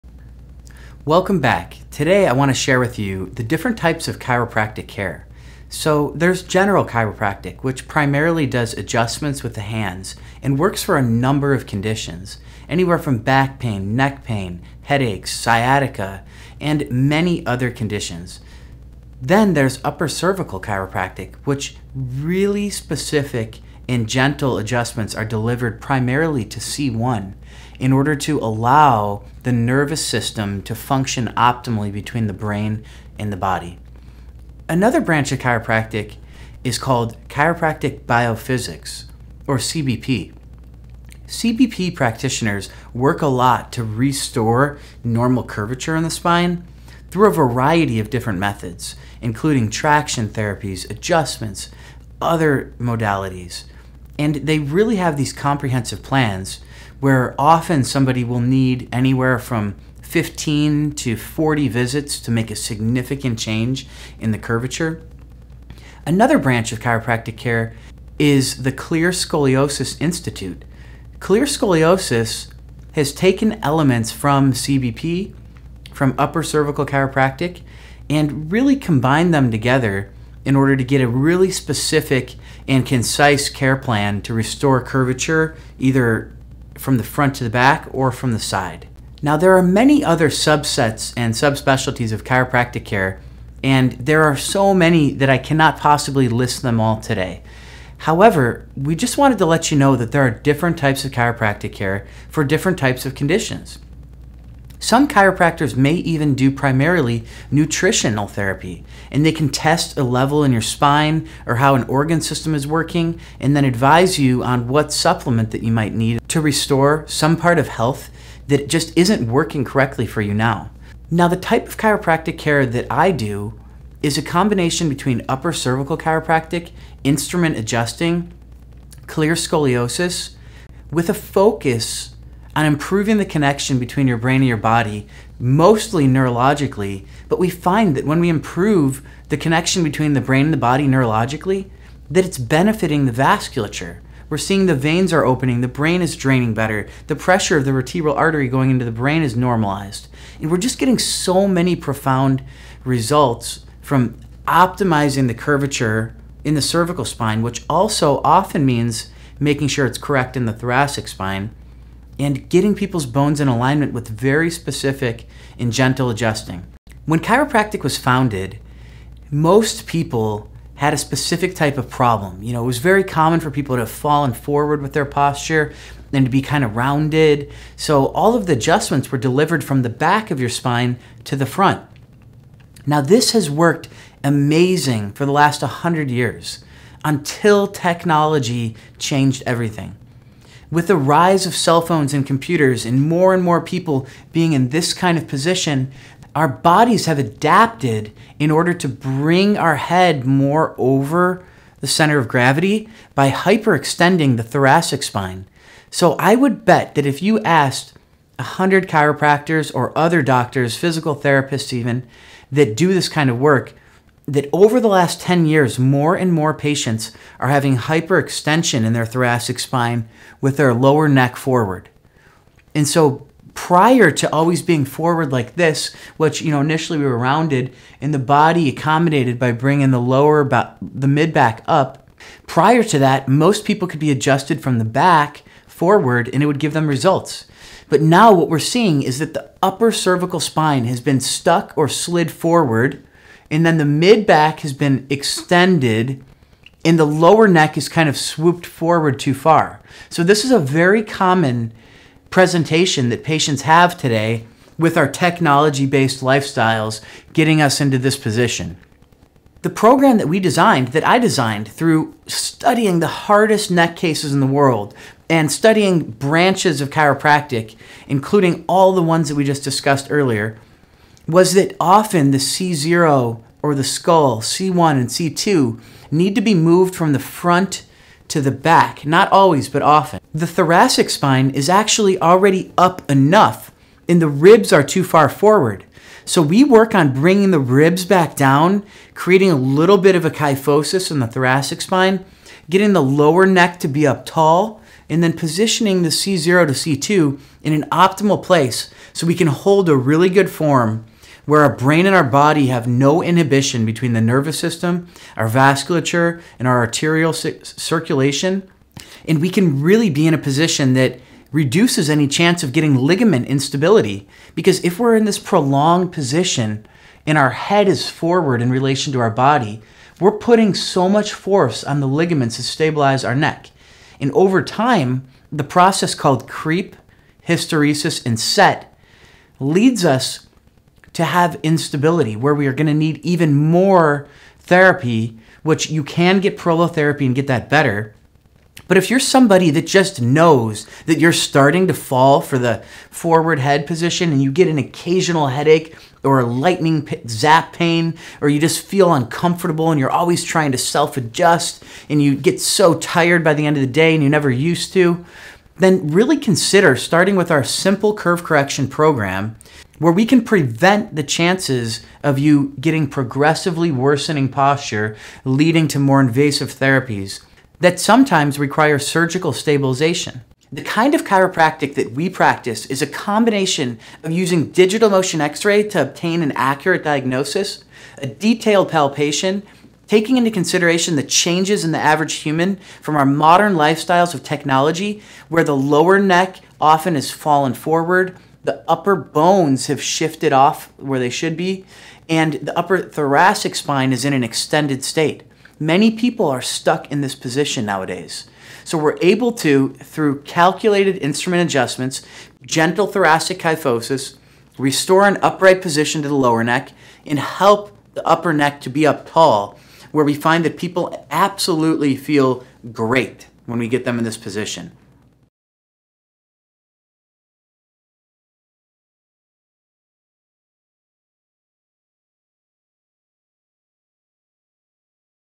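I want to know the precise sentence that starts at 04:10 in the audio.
So this is a very common presentation that patients have today with our technology-based lifestyles getting us into this position.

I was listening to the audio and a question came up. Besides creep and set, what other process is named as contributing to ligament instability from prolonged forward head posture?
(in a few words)
hysteresis.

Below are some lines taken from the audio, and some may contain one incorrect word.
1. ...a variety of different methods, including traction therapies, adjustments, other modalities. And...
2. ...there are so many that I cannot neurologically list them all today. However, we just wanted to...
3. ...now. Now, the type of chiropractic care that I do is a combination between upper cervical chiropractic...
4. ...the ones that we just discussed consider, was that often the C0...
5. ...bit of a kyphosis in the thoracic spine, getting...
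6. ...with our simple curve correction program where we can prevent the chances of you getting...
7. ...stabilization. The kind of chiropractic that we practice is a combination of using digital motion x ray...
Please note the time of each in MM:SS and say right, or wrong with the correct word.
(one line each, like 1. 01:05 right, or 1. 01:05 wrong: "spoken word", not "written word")
1. 00:47 right
2. 01:33 wrong: "possibly", not "neurologically"
3. 02:00 right
4. 04:28 wrong: "earlier", not "consider"
5. 04:49 right
6. 05:57 right
7. 06:09 right.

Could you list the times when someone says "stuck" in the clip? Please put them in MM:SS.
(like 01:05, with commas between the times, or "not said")
04:01, 06:36.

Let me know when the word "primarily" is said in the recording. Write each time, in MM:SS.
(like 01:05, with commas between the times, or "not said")
00:07, 00:25, 01:46.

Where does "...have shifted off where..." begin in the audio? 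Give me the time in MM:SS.
06:29.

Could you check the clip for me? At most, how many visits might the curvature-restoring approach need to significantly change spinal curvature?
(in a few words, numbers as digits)
40.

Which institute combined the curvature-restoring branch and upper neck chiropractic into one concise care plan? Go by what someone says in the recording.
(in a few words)
Clear Scoliosis Institute.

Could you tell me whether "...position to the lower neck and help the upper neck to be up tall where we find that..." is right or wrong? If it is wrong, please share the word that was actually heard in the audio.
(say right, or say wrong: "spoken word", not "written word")
right.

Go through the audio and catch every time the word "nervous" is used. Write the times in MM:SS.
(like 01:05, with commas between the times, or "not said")
00:29, 05:04.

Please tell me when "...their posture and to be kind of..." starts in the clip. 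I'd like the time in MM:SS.
02:54.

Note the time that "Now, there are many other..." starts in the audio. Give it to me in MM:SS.
01:29.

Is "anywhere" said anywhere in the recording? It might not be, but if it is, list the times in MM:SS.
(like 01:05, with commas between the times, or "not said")
00:12, 00:58.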